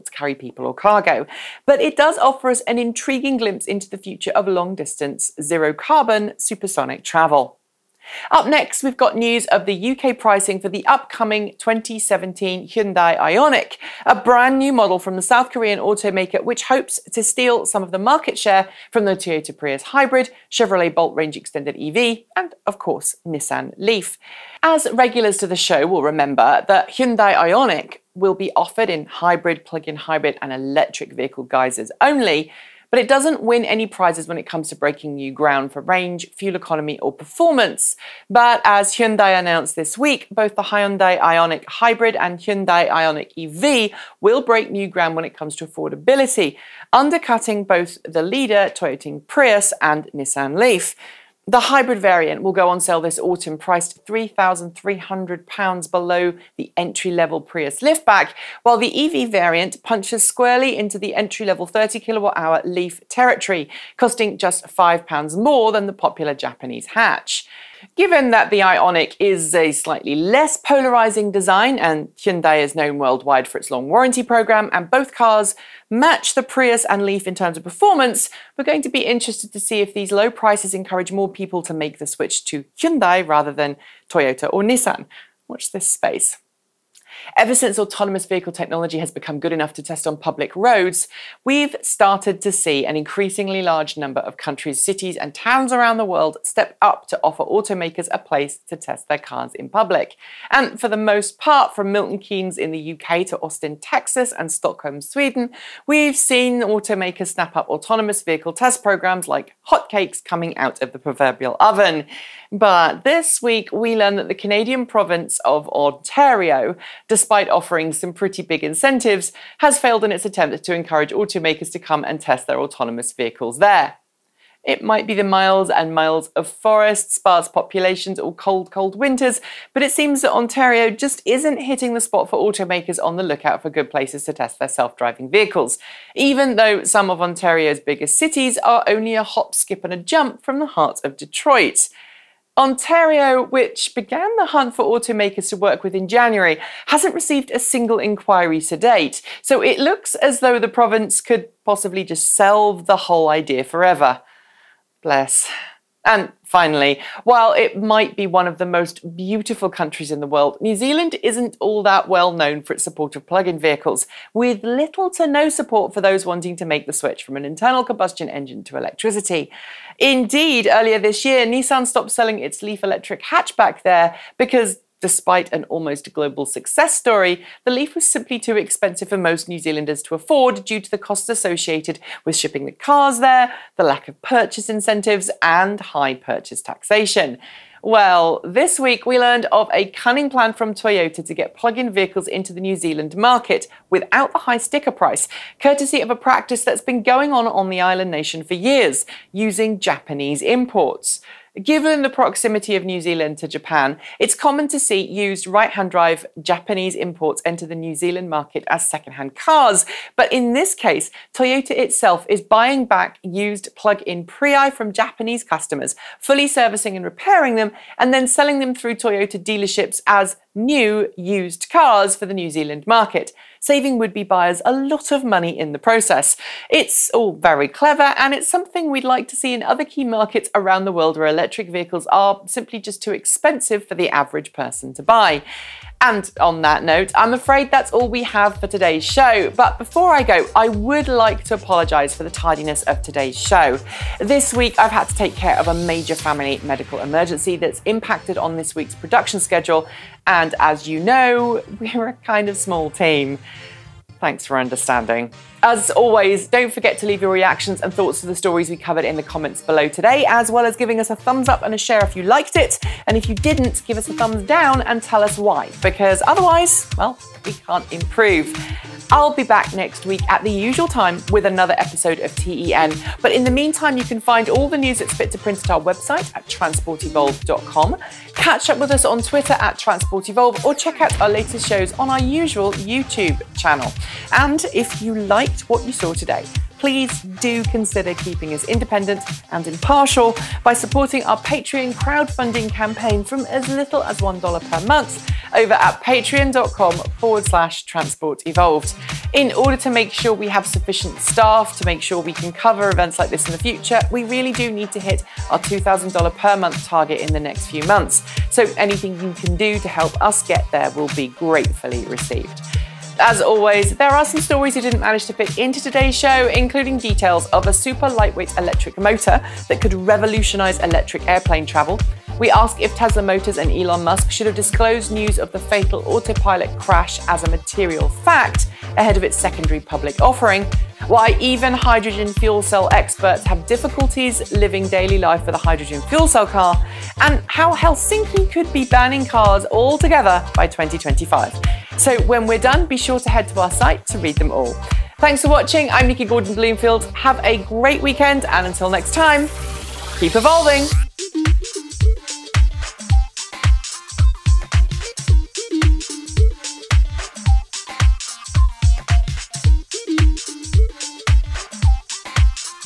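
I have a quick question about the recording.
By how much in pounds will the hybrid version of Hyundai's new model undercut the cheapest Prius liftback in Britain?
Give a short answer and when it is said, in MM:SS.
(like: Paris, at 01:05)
£3,300, at 00:54.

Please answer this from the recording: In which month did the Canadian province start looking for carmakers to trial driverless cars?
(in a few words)
January.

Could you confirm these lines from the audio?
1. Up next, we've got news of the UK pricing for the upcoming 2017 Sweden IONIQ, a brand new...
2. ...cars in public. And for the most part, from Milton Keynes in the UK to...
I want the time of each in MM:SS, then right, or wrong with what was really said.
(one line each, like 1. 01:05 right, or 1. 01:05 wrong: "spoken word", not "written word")
1. 00:08 wrong: "Hyundai", not "Sweden"
2. 01:39 right.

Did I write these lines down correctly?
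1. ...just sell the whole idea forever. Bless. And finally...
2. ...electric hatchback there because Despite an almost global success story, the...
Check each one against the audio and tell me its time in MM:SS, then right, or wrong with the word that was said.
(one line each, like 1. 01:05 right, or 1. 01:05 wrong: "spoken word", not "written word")
1. 02:32 right
2. 02:52 right.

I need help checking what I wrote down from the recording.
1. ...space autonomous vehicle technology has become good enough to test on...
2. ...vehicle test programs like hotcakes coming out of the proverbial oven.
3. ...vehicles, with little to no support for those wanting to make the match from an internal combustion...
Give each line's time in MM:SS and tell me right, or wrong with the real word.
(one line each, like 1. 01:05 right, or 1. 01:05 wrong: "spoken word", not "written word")
1. 01:27 wrong: "since", not "space"
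2. 01:48 right
3. 02:43 wrong: "switch", not "match".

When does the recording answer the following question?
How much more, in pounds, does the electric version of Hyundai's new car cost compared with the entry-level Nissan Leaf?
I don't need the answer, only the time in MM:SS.
01:04.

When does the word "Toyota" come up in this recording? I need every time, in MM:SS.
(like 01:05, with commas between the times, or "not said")
00:19, 00:48, 01:24, 03:10, 03:31, 03:38.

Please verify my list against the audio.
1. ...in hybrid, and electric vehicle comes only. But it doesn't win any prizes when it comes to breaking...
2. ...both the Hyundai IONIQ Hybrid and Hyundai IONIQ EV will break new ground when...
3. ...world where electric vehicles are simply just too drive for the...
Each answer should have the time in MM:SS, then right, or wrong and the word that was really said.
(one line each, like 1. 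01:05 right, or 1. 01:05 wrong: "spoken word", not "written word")
1. 00:29 wrong: "guises", not "comes"
2. 00:40 right
3. 03:50 wrong: "expensive", not "drive".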